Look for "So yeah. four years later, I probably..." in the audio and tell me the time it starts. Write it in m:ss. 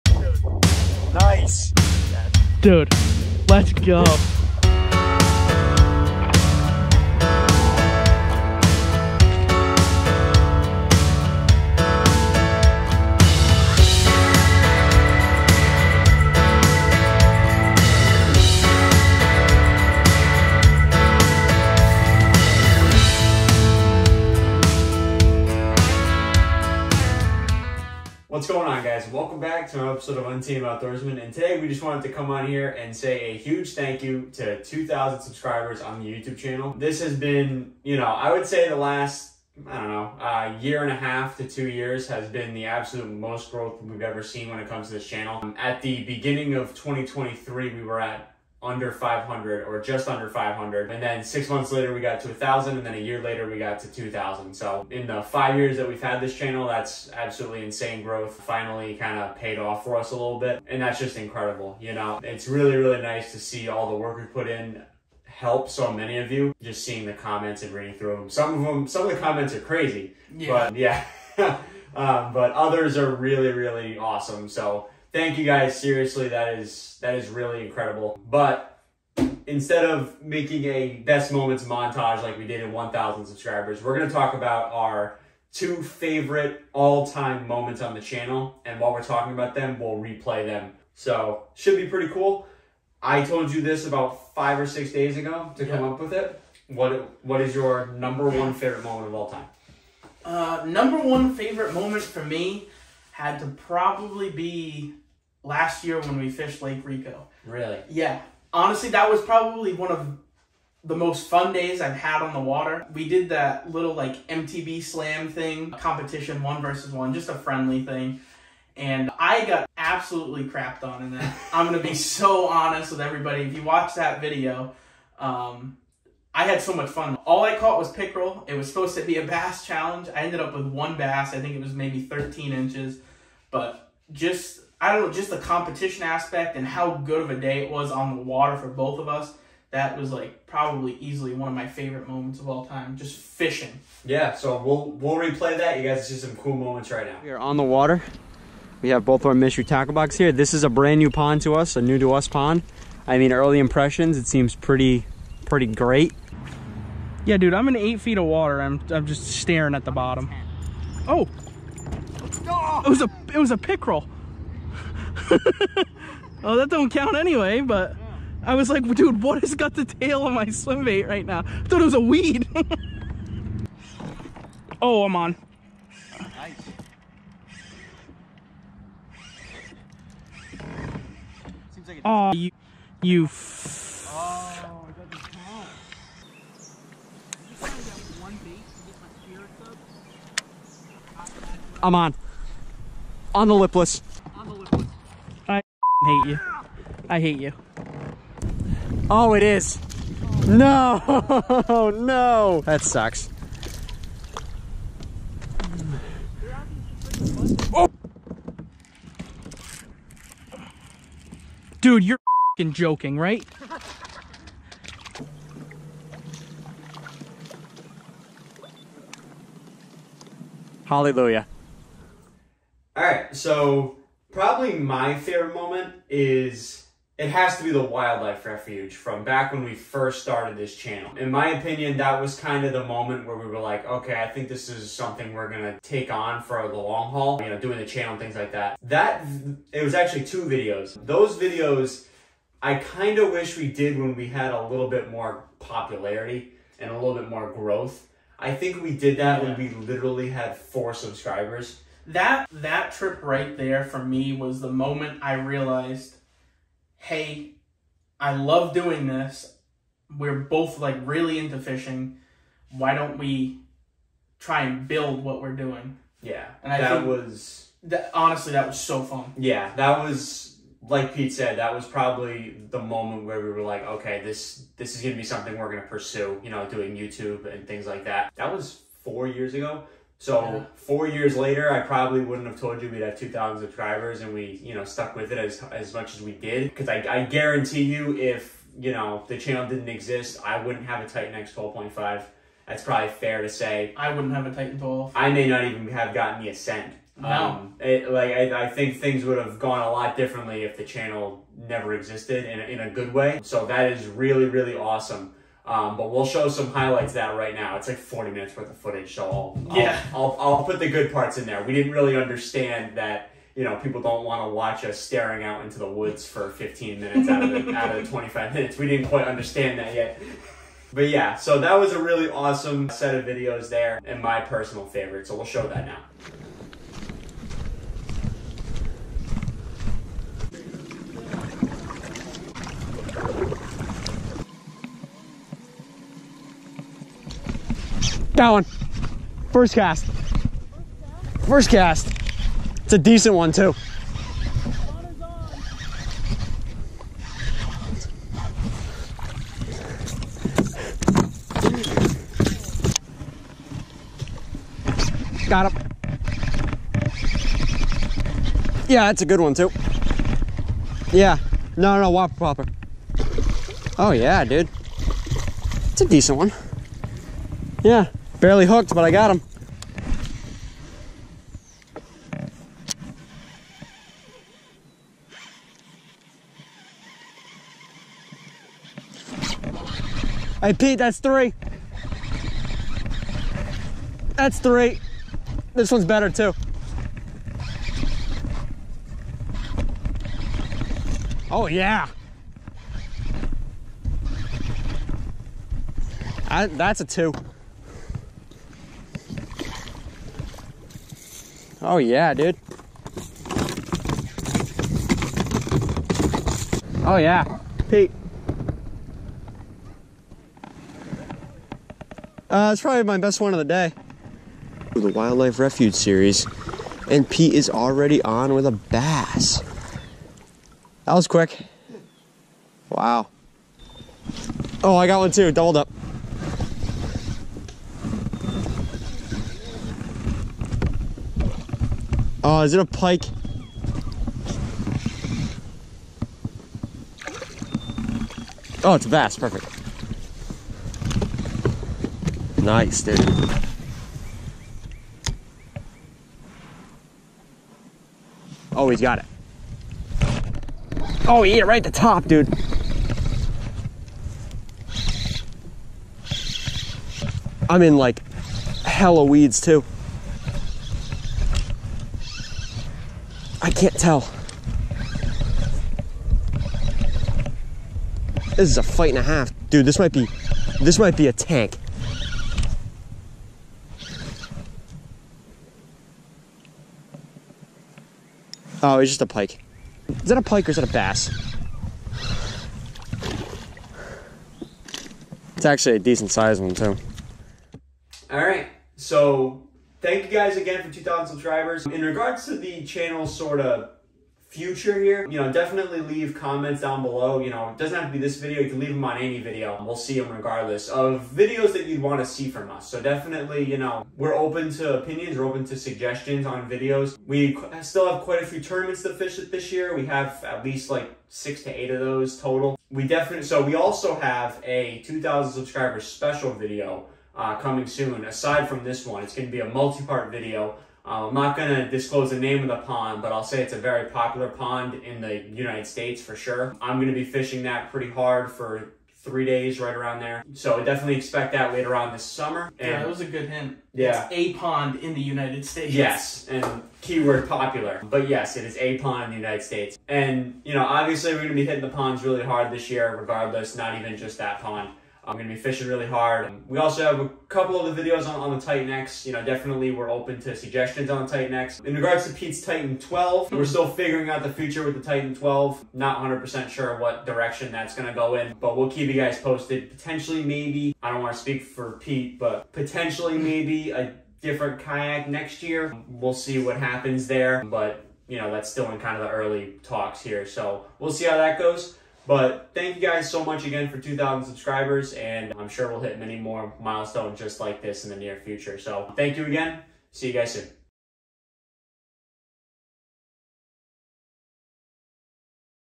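4:40.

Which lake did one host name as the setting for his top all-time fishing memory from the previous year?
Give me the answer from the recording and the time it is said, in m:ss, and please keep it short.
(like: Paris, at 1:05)
Lake Rico, at 1:46.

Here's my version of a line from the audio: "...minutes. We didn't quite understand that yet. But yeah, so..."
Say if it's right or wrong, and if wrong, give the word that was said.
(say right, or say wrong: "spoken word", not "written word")
right.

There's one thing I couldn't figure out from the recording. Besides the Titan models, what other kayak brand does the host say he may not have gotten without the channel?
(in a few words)
Ascend.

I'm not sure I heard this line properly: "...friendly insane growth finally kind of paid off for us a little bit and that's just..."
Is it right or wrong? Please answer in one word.
wrong.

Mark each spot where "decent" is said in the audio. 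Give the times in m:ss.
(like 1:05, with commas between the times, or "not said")
5:42, 6:06, 8:05.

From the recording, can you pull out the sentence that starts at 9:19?
Potentially maybe, I don't want to speak for Pete, but potentially maybe a different kayak next year.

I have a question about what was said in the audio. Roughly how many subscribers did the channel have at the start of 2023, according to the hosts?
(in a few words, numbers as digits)
500.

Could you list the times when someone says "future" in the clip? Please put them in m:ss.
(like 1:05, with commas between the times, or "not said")
8:14, 9:14, 9:38.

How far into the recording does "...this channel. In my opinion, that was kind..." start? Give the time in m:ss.
3:50.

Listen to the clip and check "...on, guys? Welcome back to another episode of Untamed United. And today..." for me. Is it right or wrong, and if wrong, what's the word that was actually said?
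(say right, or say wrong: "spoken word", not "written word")
wrong: "Outdoorsmen", not "United".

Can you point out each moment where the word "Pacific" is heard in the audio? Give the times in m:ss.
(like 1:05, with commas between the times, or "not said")
not said.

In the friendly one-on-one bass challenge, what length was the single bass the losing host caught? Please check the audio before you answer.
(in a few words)
13 inches.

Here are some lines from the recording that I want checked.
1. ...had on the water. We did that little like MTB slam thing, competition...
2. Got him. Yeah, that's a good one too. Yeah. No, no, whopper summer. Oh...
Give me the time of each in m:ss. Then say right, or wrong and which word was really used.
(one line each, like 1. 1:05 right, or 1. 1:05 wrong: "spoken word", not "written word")
1. 1:51 right
2. 5:55 wrong: "plopper", not "summer".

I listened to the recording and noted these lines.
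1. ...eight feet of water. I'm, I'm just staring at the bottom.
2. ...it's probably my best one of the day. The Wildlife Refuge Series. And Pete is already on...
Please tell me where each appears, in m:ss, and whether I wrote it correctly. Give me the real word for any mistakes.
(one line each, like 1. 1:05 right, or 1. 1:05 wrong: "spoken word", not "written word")
1. 2:37 right
2. 6:52 right.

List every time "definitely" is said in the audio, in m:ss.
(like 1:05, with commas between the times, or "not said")
8:15, 8:22, 8:33, 8:50, 9:09.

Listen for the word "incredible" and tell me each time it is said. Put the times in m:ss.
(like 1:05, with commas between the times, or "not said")
1:01, 1:17.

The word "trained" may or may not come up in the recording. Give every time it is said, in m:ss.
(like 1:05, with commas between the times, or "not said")
not said.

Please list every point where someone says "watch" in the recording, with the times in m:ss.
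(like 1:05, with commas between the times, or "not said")
2:03, 5:14.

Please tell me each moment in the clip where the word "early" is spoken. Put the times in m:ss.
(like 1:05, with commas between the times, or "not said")
2:33, 9:29.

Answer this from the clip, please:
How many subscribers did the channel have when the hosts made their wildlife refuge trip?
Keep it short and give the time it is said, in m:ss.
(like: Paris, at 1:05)
4, at 4:10.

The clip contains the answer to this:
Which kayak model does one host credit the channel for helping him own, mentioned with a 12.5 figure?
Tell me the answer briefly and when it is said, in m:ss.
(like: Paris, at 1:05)
Titan X 12.5, at 4:51.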